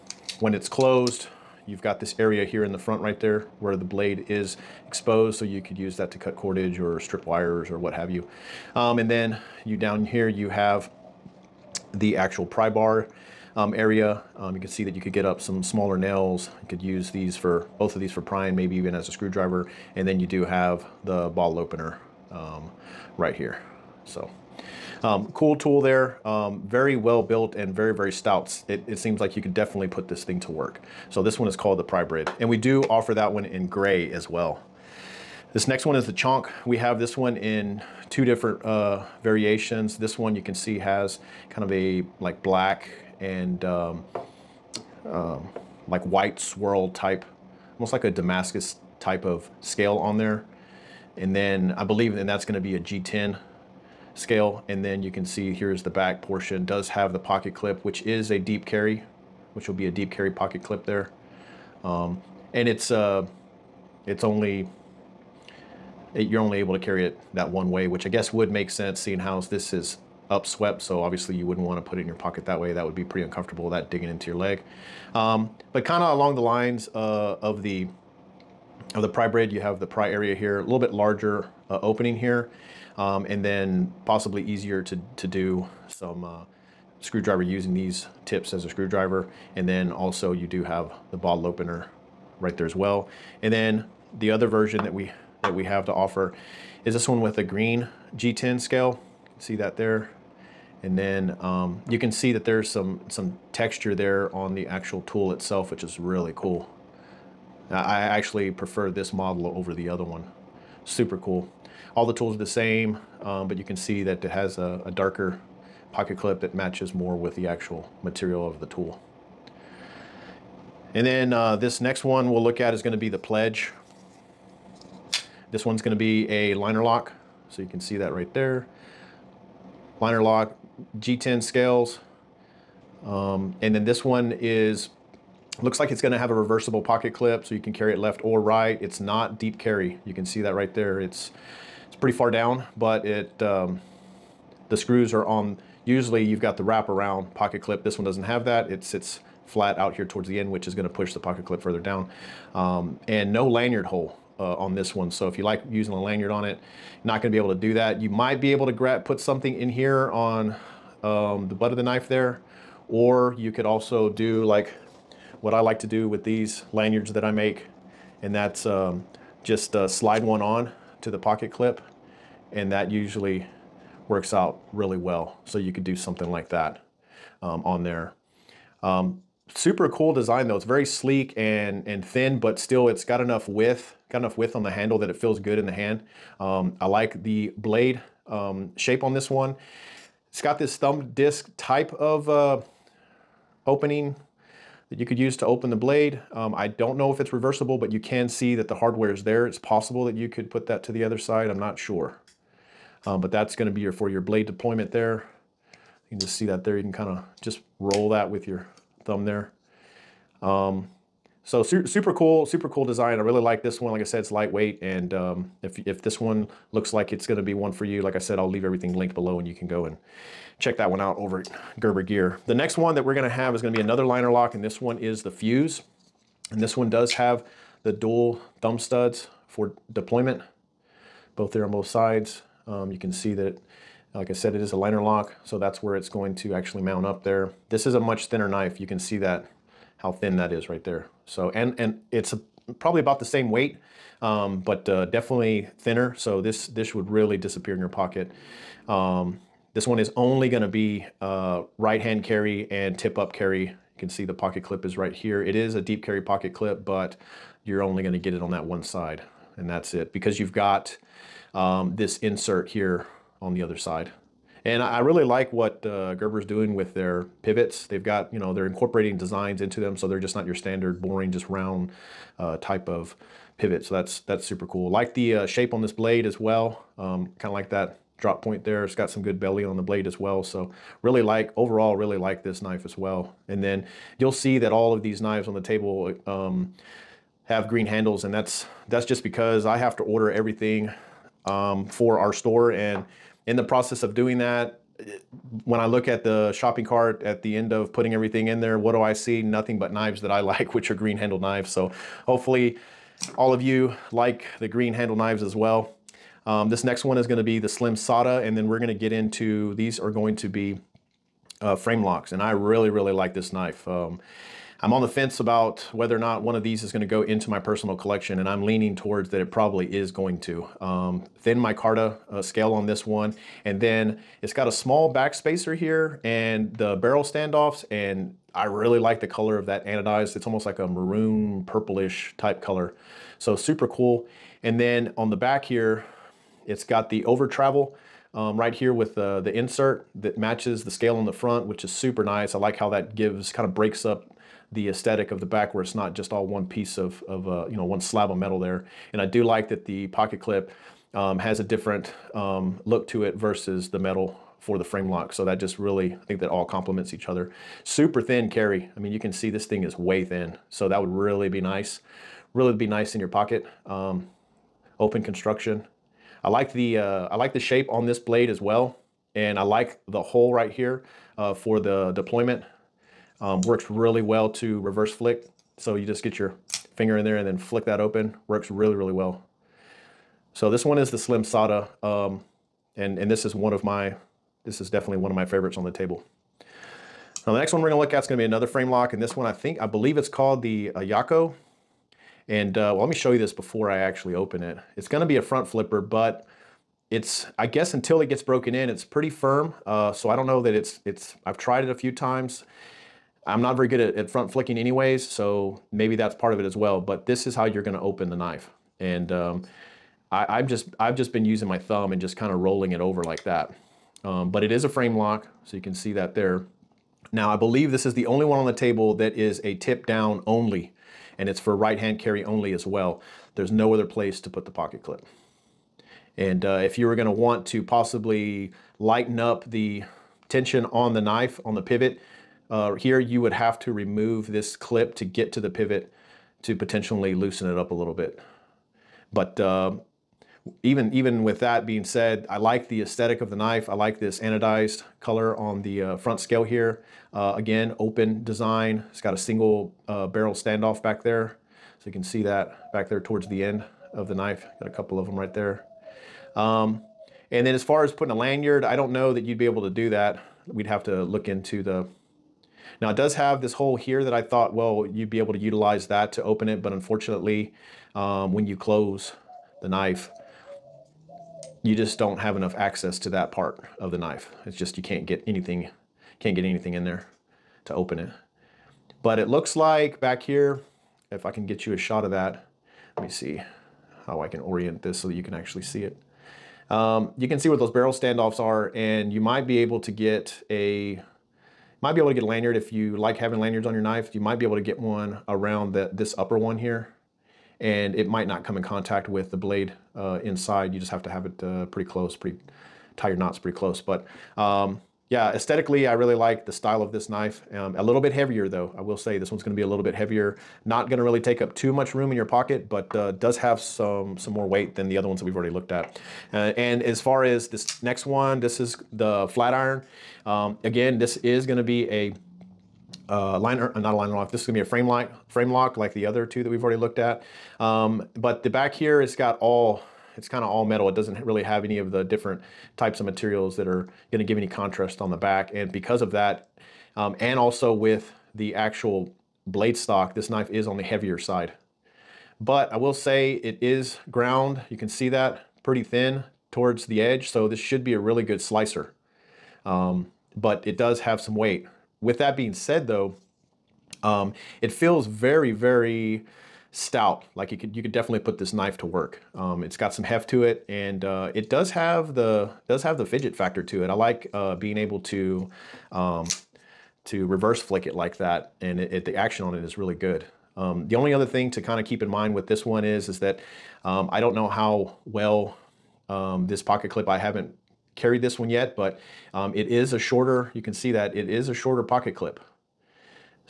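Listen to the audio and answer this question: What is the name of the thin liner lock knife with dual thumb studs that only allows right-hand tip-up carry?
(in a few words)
Fuse.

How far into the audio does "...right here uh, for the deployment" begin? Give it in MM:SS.
06:10.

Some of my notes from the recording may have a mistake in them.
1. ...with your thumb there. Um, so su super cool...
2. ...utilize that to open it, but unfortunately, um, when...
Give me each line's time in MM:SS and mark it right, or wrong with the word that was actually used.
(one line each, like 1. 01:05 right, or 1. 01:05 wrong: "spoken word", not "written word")
1. 03:28 right
2. 07:45 right.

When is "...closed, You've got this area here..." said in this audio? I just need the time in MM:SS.
00:00.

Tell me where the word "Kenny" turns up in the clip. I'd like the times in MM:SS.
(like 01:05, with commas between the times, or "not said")
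not said.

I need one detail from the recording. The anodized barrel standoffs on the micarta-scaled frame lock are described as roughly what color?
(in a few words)
maroon purplish.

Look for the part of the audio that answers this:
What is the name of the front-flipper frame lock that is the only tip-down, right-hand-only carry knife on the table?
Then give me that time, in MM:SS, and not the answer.
06:31.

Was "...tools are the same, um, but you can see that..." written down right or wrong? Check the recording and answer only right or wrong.
right.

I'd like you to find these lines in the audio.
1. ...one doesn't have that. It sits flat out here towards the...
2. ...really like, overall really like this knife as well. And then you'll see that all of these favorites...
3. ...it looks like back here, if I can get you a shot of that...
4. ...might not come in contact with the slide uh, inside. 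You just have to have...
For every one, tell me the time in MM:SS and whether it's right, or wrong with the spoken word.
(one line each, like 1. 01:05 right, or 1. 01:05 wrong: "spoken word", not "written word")
1. 02:27 right
2. 04:41 wrong: "knives", not "favorites"
3. 07:59 right
4. 08:18 wrong: "blade", not "slide".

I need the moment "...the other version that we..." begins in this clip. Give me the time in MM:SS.
01:34.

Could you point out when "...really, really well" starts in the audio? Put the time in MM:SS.
06:18.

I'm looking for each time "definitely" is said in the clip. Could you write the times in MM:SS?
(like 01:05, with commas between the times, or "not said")
00:29, 04:05, 06:24, 09:18.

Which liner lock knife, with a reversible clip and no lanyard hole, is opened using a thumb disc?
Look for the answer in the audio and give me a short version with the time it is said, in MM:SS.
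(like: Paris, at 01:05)
Pledge, at 02:03.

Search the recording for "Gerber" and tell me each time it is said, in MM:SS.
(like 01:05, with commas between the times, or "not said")
03:41, 04:26.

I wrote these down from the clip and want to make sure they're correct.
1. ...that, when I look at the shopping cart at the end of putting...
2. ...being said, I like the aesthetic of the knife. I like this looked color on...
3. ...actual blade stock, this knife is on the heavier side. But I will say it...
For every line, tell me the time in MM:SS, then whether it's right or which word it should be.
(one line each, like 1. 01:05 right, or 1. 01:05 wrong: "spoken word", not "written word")
1. 04:54 right
2. 07:21 wrong: "anodized", not "looked"
3. 08:58 right.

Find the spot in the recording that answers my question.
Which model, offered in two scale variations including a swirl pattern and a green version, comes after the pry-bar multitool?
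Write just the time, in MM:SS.
00:36.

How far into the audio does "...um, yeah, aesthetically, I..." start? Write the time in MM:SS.
08:24.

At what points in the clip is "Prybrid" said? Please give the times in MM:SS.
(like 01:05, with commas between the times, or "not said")
00:31, 01:19.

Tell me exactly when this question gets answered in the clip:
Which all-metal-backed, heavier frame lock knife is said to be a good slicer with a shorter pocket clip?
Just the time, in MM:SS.
08:39.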